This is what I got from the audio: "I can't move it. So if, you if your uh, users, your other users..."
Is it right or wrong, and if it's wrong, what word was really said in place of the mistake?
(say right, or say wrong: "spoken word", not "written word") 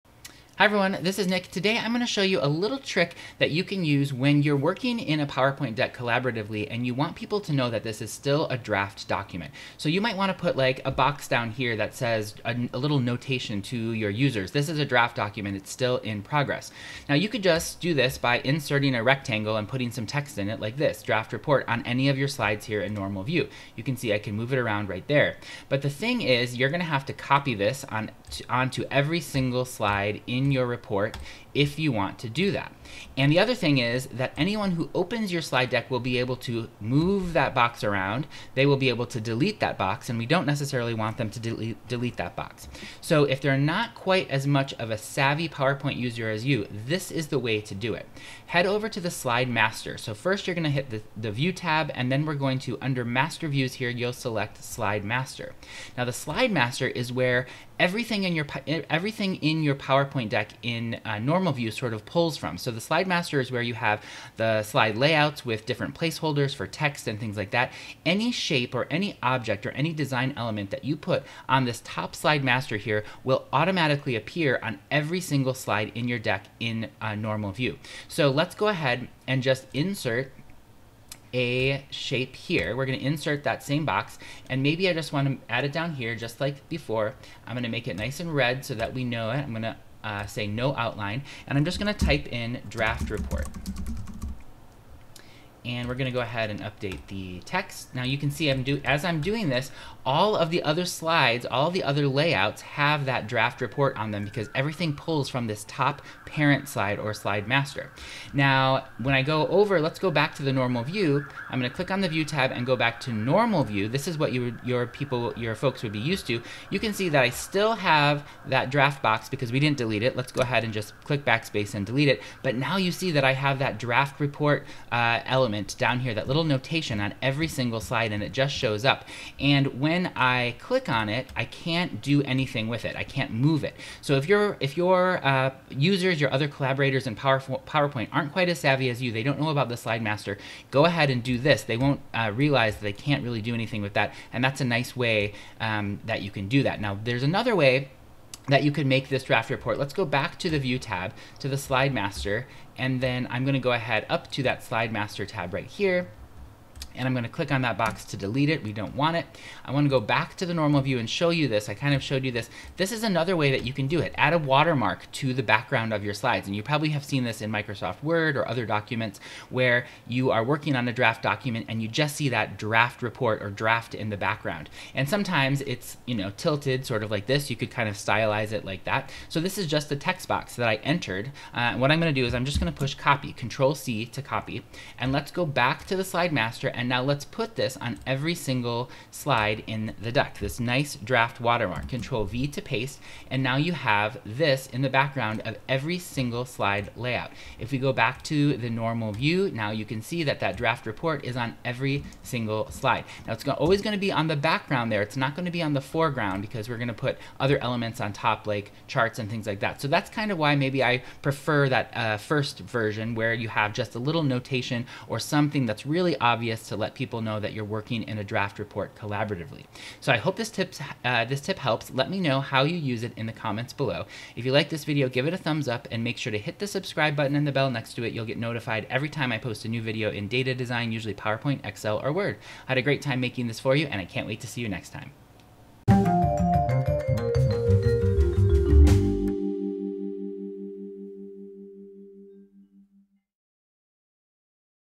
wrong: "collaborators", not "users".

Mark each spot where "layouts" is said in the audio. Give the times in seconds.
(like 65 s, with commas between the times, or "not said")
64 s, 102 s, 196 s.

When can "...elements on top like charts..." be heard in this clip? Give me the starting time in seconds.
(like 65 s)
207 s.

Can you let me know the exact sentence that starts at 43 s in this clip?
So if they're not quite as much of a savvy PowerPoint user as you, this is the way to do it.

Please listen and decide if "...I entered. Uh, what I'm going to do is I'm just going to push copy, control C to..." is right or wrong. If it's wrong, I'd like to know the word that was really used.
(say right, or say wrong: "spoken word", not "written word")
right.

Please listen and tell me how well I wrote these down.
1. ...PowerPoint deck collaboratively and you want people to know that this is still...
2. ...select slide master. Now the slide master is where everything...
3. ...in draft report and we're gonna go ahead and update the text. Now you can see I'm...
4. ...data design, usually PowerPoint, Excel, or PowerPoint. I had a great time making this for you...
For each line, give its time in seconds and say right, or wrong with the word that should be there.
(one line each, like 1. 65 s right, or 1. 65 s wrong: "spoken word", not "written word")
1. 5 s right
2. 54 s right
3. 92 s right
4. 230 s wrong: "Word", not "PowerPoint".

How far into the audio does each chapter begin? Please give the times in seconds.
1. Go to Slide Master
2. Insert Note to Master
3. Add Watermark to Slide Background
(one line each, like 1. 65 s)
1. 50 s
2. 80 s
3. 148 s.